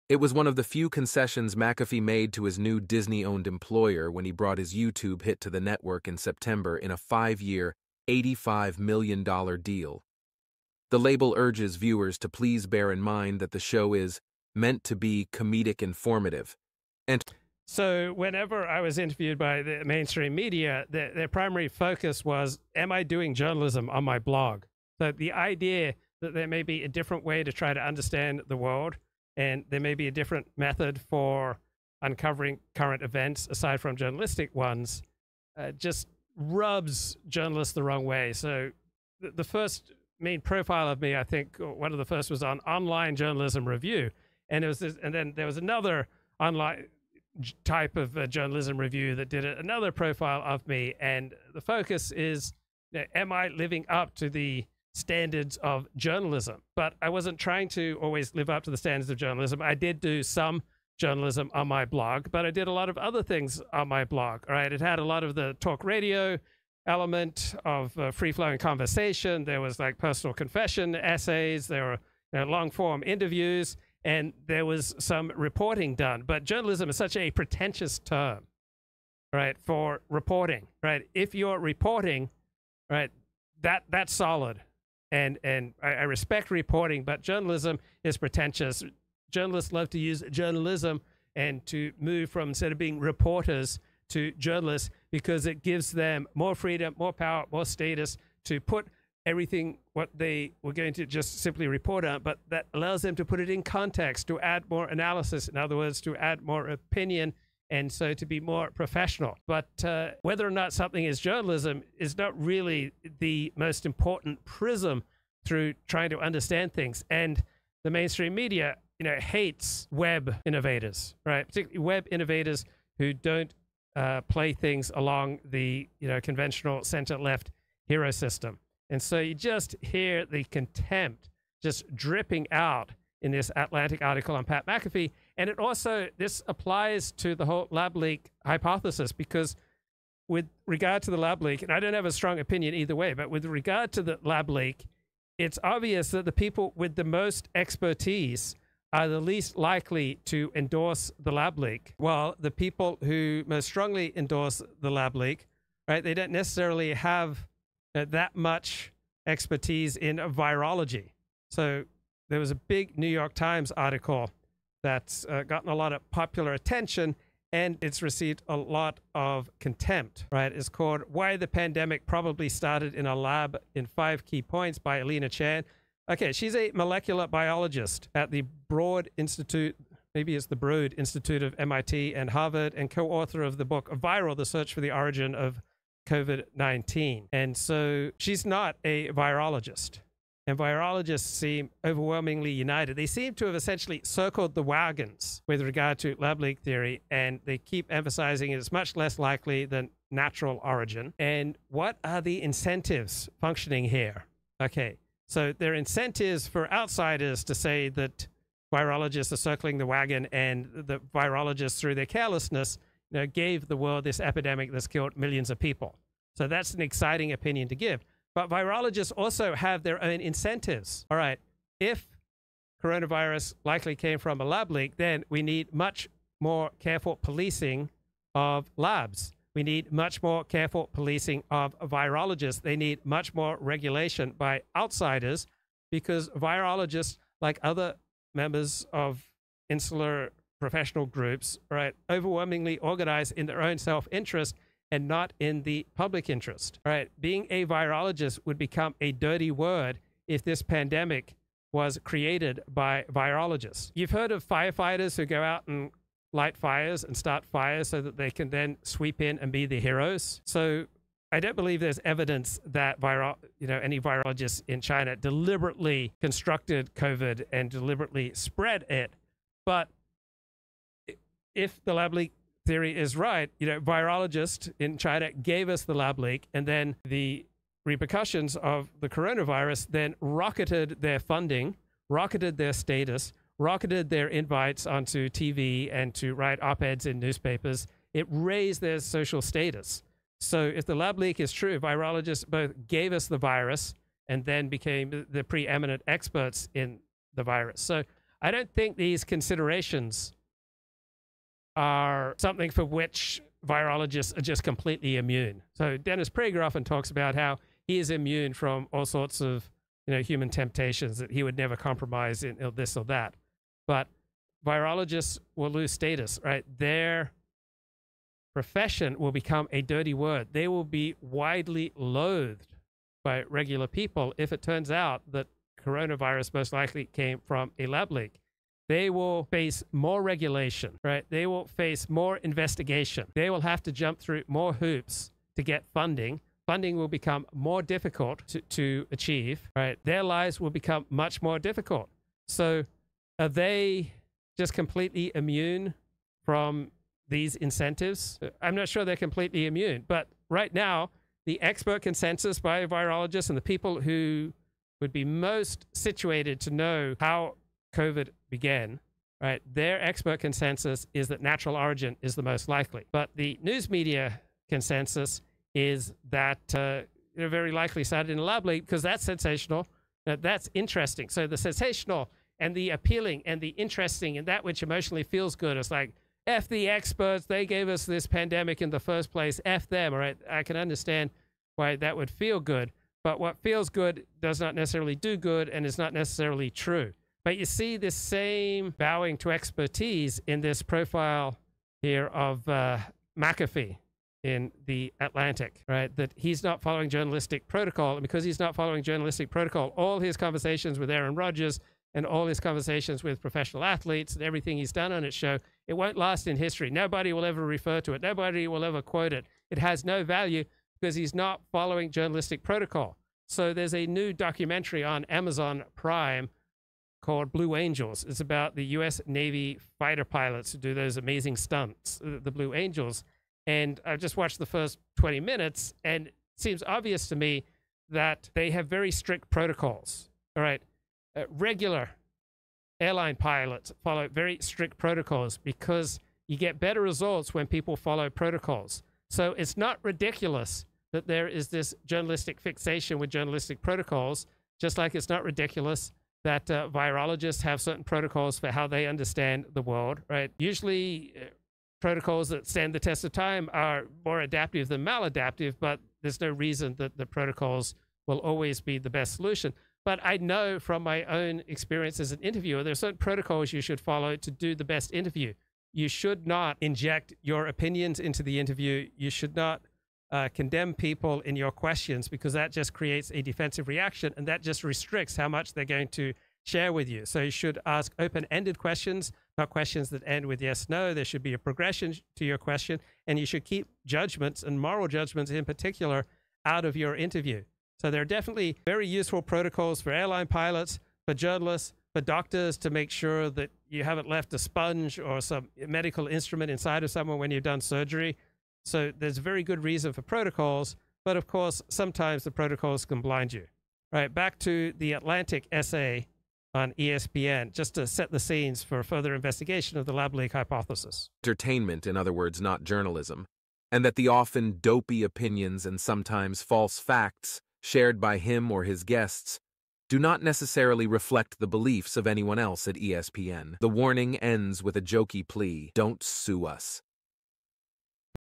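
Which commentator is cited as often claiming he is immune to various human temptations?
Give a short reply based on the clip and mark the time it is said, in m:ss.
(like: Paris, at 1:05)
Dennis Prager, at 5:05.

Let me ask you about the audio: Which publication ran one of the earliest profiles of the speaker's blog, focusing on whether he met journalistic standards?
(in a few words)
Online Journalism Review.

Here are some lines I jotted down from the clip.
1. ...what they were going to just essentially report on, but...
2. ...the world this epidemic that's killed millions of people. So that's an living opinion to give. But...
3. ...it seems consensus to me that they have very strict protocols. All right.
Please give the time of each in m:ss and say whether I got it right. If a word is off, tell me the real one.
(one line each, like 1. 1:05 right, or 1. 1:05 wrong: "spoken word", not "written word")
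1. 1:39 wrong: "simply", not "essentially"
2. 3:33 wrong: "exciting", not "living"
3. 7:06 wrong: "obvious", not "consensus".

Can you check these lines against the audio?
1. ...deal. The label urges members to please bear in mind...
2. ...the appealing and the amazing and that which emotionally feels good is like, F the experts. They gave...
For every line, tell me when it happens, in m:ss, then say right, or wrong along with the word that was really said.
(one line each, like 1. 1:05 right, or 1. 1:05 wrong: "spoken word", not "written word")
1. 0:09 wrong: "viewers", not "members"
2. 6:12 wrong: "interesting", not "amazing".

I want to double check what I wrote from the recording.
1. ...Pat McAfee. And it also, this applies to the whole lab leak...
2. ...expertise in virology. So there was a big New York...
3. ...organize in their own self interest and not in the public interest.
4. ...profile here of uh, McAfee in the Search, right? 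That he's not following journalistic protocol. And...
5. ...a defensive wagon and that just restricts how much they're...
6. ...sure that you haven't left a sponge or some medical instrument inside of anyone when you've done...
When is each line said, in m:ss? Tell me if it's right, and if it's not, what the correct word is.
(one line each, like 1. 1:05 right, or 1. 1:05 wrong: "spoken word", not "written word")
1. 2:14 right
2. 2:39 right
3. 4:02 right
4. 6:30 wrong: "Atlantic", not "Search"
5. 7:53 wrong: "reaction", not "wagon"
6. 8:13 wrong: "someone", not "anyone".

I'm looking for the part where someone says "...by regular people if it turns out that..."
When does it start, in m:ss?
5:23.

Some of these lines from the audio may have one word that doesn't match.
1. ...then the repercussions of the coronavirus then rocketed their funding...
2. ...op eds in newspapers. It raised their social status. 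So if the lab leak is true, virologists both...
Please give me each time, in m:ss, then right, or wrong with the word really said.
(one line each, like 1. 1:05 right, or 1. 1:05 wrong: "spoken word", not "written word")
1. 4:36 right
2. 4:46 right.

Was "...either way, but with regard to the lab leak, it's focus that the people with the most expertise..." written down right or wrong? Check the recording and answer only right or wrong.
wrong.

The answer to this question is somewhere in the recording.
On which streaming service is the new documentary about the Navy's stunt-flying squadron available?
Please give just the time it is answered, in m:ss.
6:55.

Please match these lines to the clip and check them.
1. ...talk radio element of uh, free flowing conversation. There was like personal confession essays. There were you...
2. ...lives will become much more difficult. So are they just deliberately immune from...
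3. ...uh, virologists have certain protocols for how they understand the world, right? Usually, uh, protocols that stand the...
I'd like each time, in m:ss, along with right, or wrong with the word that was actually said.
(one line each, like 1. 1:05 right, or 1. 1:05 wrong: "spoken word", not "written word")
1. 1:05 right
2. 5:40 wrong: "completely", not "deliberately"
3. 7:26 right.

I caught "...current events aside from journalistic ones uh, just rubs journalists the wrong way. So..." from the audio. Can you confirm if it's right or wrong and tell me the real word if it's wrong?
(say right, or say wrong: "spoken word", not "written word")
right.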